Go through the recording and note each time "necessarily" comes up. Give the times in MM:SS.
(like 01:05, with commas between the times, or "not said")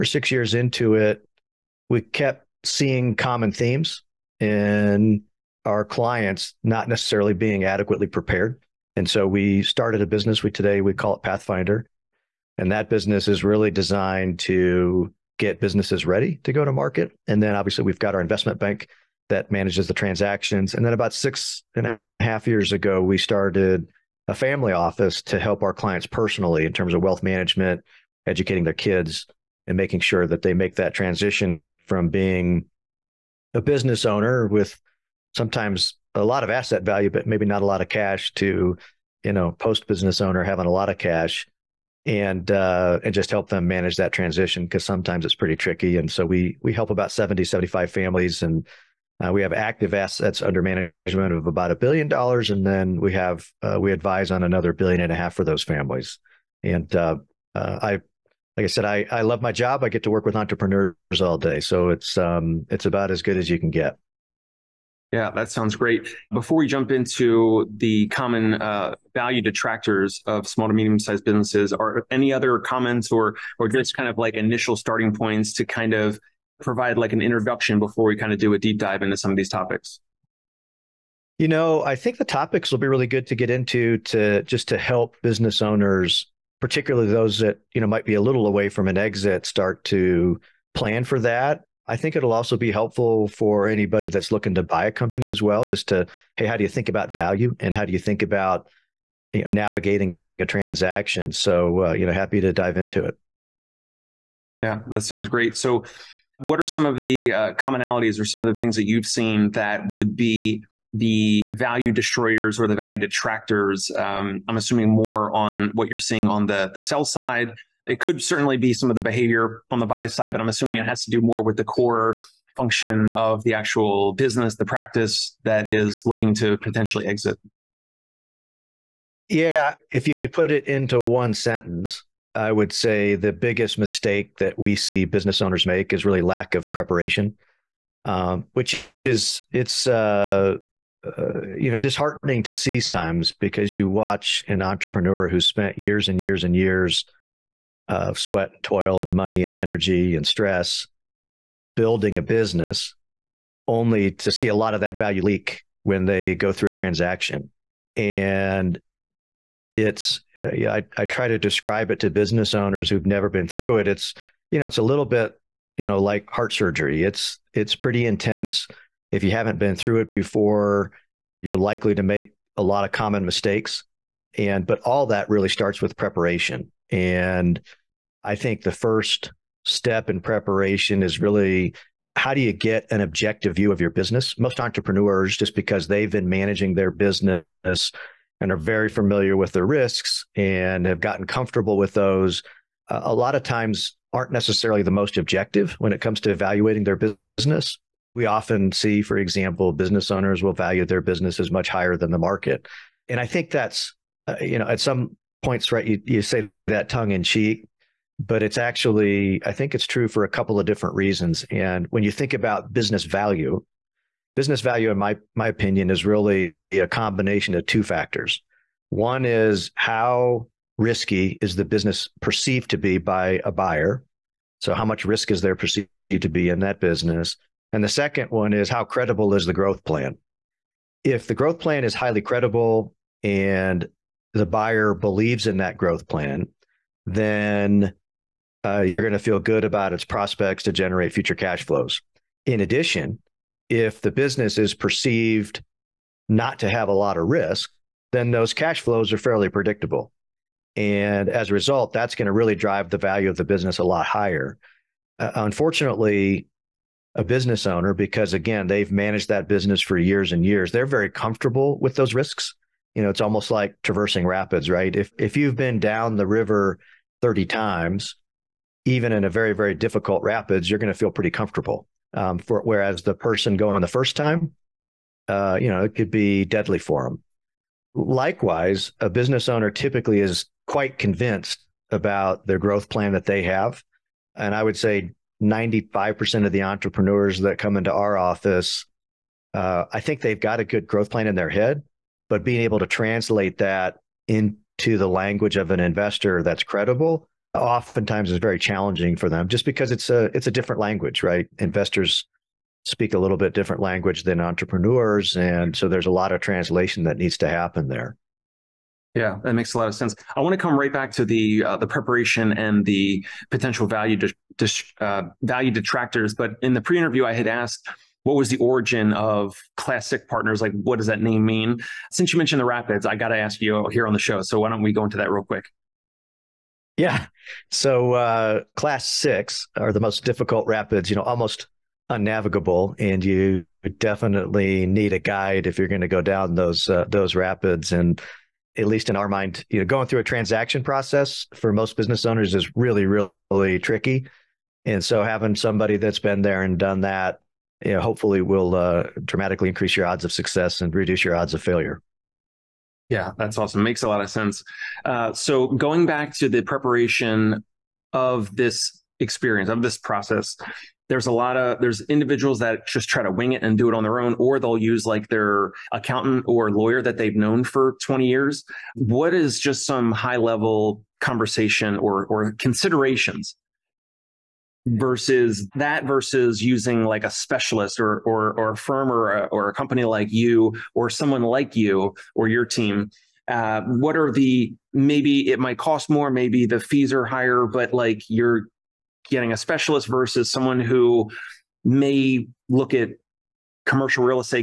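00:06, 03:14.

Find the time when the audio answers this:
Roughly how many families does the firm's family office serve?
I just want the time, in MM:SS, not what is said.
00:47.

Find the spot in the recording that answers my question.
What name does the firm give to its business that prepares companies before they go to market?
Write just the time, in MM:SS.
00:11.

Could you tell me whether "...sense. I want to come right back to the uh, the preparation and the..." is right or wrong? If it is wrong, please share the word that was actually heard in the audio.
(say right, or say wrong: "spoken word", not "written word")
right.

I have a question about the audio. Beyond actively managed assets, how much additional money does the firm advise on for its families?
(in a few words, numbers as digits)
$1.5 billion.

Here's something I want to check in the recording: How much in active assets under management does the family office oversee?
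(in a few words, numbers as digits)
$1 billion.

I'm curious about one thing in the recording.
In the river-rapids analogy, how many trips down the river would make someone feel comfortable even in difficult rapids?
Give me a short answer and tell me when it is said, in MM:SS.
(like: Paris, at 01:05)
30, at 04:27.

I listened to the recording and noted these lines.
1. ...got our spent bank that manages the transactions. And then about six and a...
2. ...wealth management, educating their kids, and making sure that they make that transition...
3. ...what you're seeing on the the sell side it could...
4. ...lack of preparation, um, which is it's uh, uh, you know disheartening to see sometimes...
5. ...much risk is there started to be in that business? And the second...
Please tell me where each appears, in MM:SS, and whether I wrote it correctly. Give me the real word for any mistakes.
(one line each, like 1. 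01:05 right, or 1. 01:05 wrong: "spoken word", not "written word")
1. 00:17 wrong: "investment", not "spent"
2. 00:27 right
3. 01:55 right
4. 02:16 right
5. 03:44 wrong: "perceived", not "started".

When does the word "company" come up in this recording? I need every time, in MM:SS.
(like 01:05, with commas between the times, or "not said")
01:34, 06:19.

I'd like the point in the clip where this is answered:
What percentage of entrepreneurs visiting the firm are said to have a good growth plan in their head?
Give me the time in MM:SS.
04:45.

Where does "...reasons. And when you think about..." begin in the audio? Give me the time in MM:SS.
03:30.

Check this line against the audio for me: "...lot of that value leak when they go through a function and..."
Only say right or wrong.
wrong.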